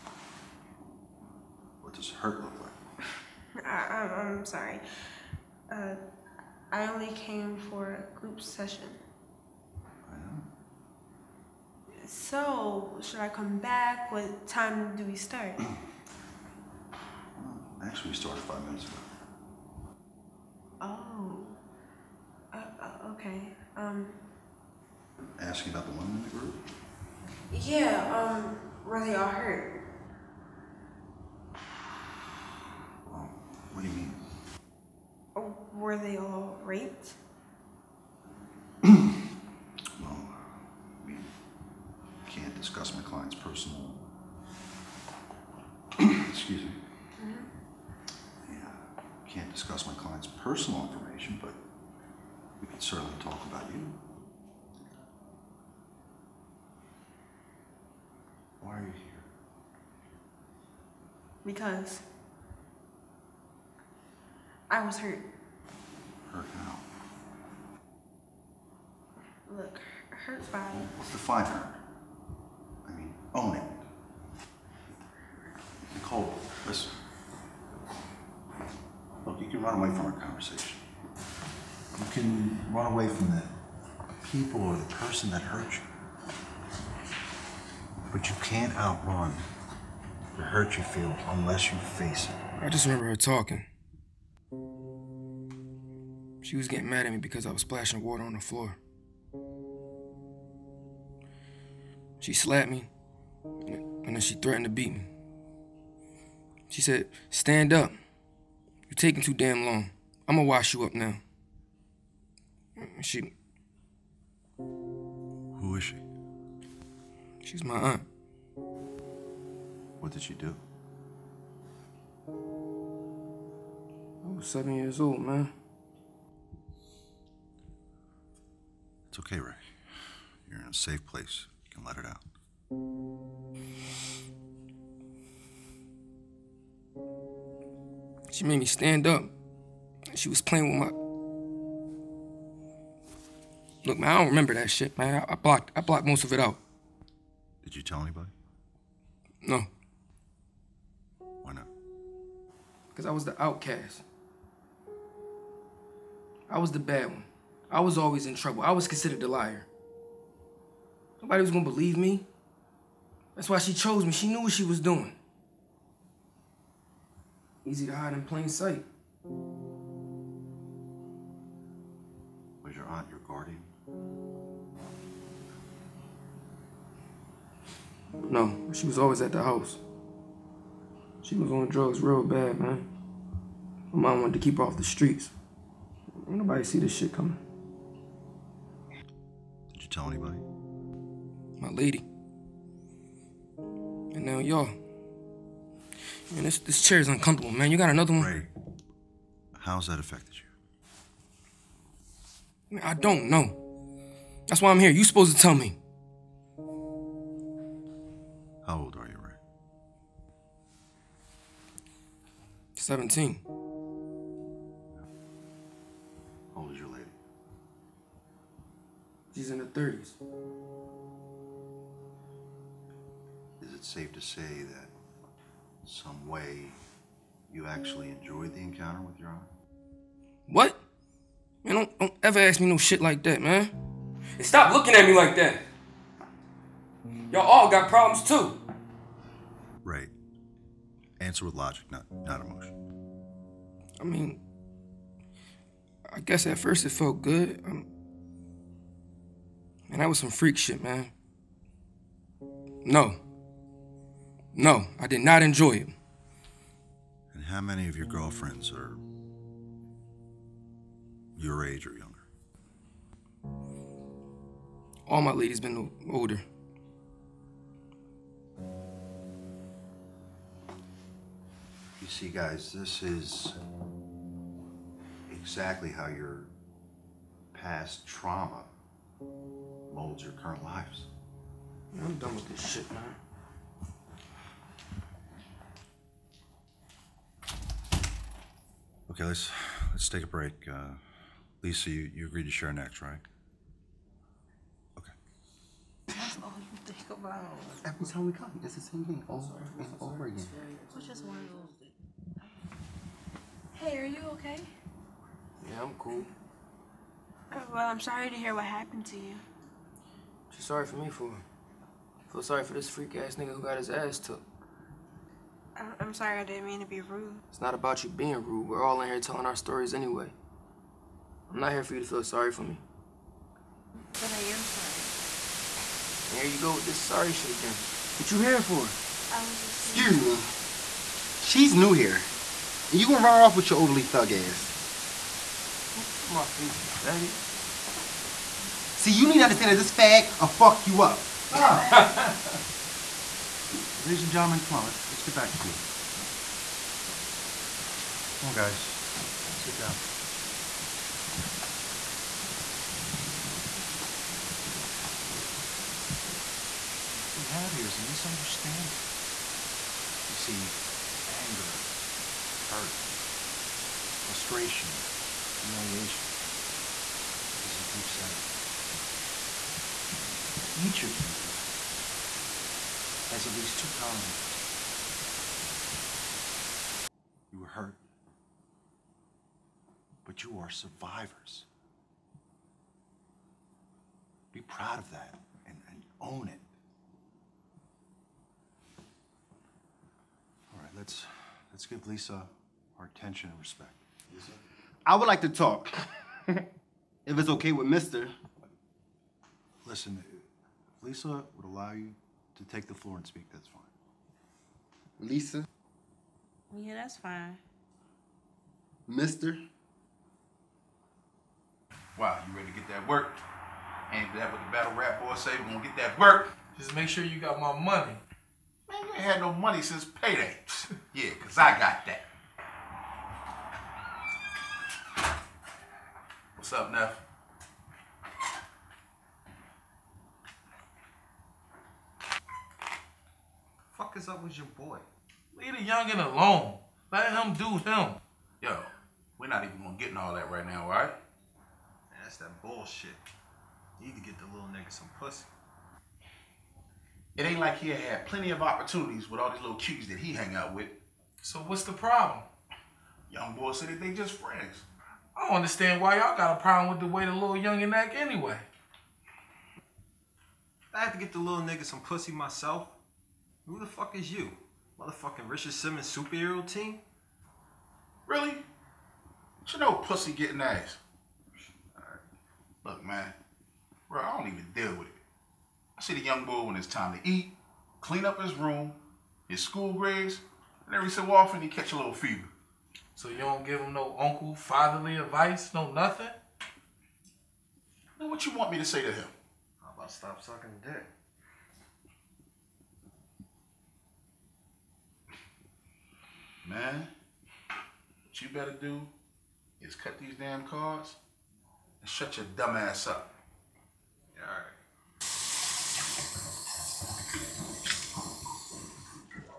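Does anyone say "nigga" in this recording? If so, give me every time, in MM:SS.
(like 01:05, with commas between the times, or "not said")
05:13, 07:24, 07:41.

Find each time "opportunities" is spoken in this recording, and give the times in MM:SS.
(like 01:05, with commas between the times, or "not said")
07:28.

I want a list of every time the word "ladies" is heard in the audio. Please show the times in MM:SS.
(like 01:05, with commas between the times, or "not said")
04:25, 05:44.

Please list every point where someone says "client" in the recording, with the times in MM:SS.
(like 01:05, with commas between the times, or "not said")
00:43, 00:49.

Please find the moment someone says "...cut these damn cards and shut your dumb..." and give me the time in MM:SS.
08:19.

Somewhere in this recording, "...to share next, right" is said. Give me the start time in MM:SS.
04:52.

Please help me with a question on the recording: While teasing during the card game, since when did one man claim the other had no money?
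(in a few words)
Since payday.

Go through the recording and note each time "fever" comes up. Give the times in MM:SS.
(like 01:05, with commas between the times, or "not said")
08:02.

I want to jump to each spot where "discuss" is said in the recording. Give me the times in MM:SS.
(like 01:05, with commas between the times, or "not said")
00:42, 00:49.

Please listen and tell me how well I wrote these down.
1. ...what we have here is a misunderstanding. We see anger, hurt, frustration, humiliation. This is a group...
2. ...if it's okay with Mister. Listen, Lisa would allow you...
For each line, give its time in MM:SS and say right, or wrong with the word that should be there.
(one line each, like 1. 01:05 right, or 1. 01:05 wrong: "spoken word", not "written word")
1. 05:57 right
2. 06:36 right.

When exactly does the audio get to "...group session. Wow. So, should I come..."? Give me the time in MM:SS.
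00:08.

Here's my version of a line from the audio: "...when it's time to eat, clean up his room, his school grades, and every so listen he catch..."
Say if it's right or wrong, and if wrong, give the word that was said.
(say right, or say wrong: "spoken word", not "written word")
wrong: "often", not "listen".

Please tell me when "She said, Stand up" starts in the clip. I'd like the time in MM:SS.
01:46.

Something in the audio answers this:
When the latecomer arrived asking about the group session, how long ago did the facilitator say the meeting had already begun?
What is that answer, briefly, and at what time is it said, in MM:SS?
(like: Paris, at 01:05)
5 minutes ago, at 00:18.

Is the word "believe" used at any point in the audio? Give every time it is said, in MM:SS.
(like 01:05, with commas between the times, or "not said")
02:41.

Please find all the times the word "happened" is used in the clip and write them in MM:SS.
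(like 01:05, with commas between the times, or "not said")
05:08.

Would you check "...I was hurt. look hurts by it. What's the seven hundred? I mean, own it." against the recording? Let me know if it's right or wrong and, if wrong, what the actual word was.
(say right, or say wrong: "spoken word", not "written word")
wrong: "five", not "seven".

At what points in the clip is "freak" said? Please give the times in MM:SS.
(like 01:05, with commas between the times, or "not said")
04:10, 05:12.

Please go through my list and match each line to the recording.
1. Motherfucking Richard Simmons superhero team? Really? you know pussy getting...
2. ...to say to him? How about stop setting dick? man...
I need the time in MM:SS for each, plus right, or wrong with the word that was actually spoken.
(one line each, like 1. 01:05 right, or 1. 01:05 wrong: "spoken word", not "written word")
1. 07:45 right
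2. 08:08 wrong: "sucking", not "setting".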